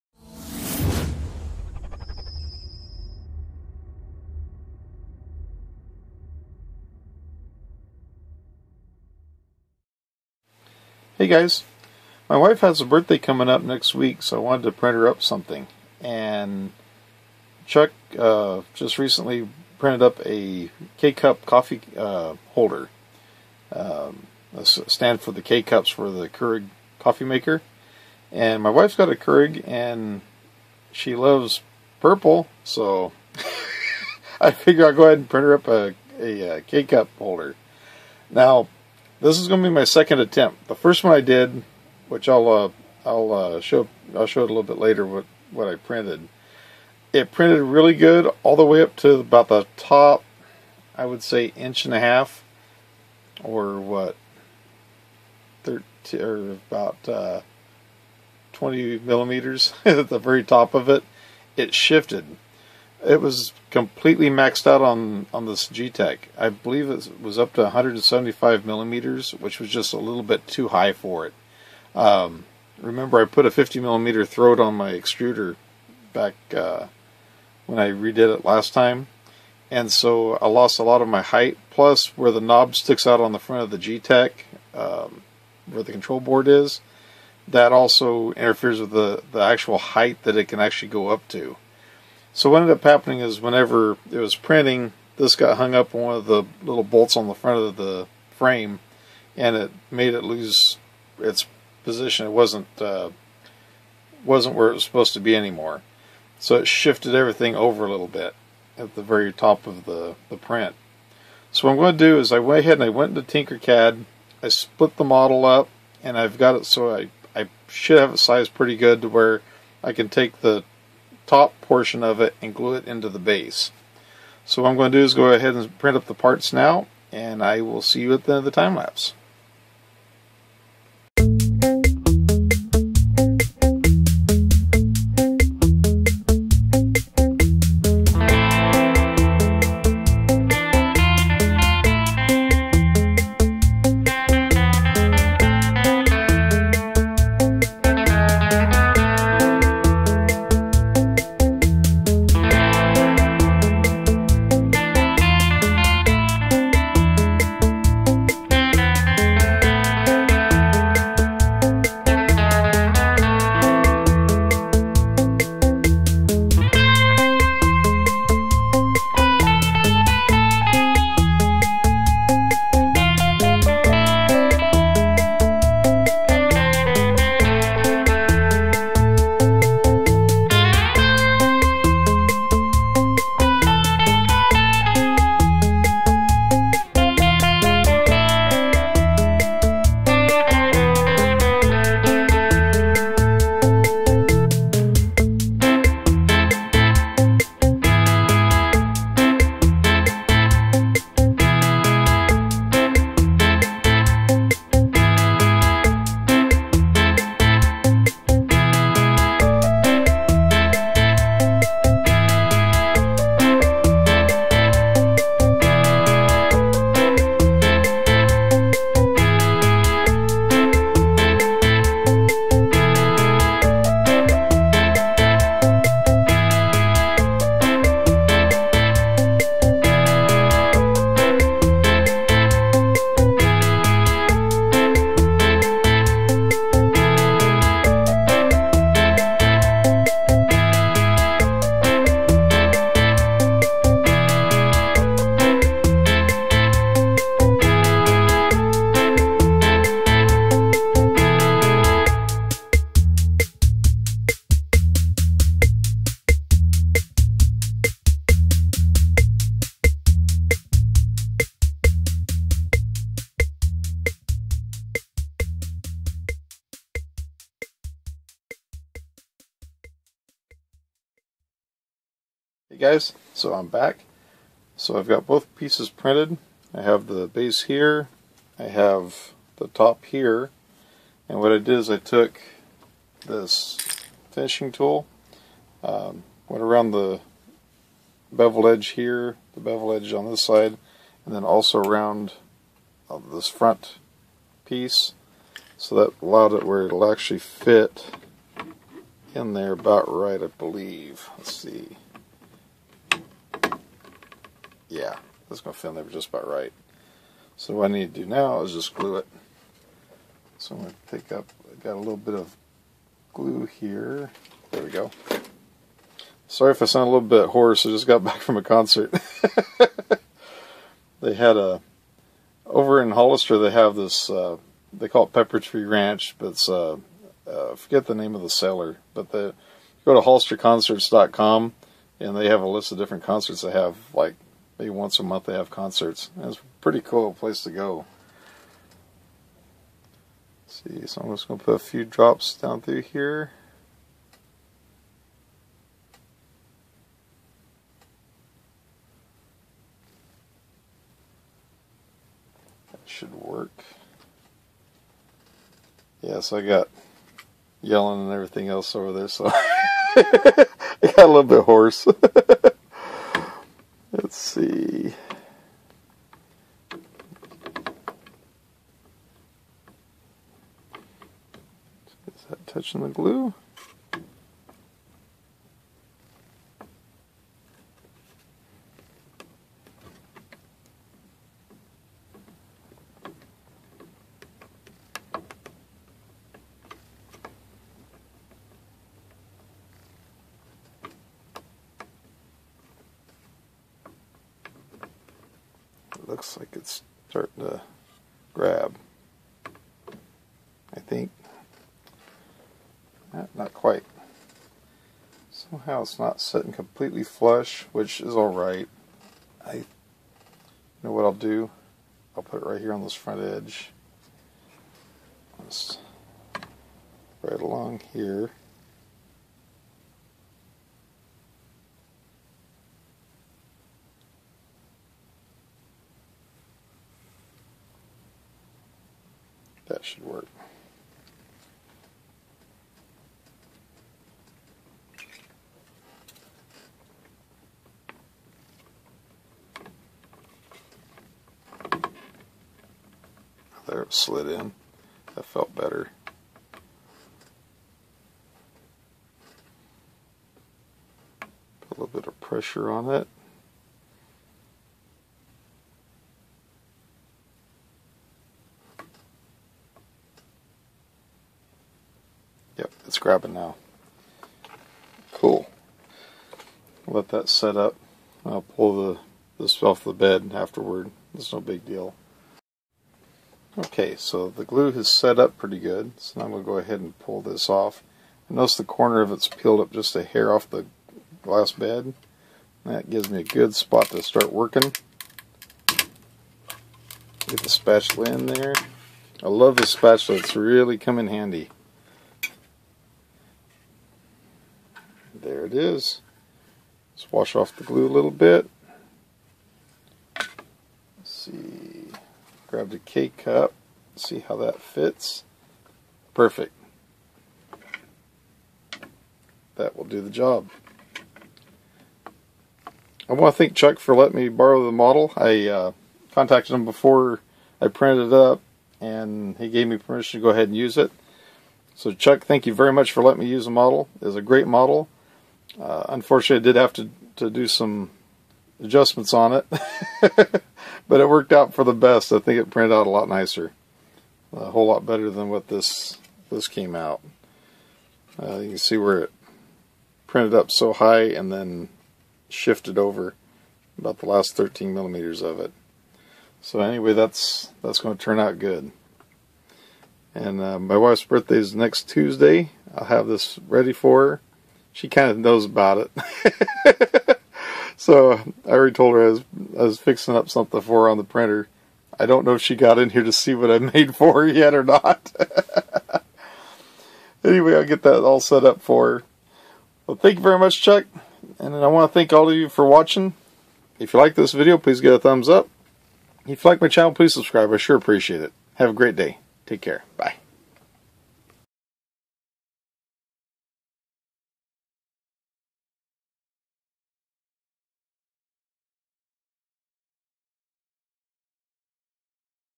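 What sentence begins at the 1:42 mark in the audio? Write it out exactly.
It wasn't uh, wasn't where it was supposed to be anymore.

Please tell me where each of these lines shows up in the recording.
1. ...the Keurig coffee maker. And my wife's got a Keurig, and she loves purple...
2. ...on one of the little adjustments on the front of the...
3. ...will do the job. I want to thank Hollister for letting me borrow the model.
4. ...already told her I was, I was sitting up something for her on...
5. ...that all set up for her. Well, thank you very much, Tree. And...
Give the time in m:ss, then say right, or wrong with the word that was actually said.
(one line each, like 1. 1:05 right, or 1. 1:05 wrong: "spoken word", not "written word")
1. 0:26 right
2. 1:35 wrong: "bolts", not "adjustments"
3. 8:29 wrong: "Chuck", not "Hollister"
4. 9:18 wrong: "fixing", not "sitting"
5. 9:28 wrong: "Chuck", not "Tree".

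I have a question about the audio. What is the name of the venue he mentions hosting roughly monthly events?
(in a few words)
Pepper Tree Ranch.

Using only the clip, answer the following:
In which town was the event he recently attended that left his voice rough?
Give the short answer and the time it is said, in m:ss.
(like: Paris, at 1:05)
Hollister, at 5:23.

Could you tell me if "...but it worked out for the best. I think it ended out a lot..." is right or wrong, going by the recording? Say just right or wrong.
wrong.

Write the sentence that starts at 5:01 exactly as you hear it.
Let's see yeah, that's going to fit in there just about right.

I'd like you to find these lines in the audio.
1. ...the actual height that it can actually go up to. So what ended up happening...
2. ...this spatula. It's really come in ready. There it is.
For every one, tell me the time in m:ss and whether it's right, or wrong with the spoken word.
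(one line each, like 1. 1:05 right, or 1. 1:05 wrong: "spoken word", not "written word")
1. 1:29 right
2. 8:09 wrong: "handy", not "ready".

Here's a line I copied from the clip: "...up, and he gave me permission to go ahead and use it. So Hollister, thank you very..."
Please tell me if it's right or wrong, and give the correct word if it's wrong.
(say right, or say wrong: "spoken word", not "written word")
wrong: "Chuck", not "Hollister".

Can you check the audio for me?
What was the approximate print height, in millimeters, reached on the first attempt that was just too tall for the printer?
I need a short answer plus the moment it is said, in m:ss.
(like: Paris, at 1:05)
175, at 1:07.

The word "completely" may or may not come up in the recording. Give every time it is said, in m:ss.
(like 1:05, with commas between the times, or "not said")
1:03, 6:46.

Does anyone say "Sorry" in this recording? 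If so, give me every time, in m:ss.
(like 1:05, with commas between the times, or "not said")
5:16.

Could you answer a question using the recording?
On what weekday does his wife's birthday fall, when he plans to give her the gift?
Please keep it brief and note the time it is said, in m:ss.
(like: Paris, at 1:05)
Tuesday, at 9:12.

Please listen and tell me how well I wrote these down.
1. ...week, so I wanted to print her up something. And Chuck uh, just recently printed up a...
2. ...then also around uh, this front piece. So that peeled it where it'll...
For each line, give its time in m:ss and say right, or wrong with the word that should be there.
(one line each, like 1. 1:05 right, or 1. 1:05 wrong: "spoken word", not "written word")
1. 0:13 right
2. 4:51 wrong: "allowed", not "peeled".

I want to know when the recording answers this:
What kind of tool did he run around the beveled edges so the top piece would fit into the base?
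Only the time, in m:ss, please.
4:44.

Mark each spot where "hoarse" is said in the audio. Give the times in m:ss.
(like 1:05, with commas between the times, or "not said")
5:17, 6:01.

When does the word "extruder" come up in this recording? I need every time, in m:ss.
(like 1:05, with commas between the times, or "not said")
1:14.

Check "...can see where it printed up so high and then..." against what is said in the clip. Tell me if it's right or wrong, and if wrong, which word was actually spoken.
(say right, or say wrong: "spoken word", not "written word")
right.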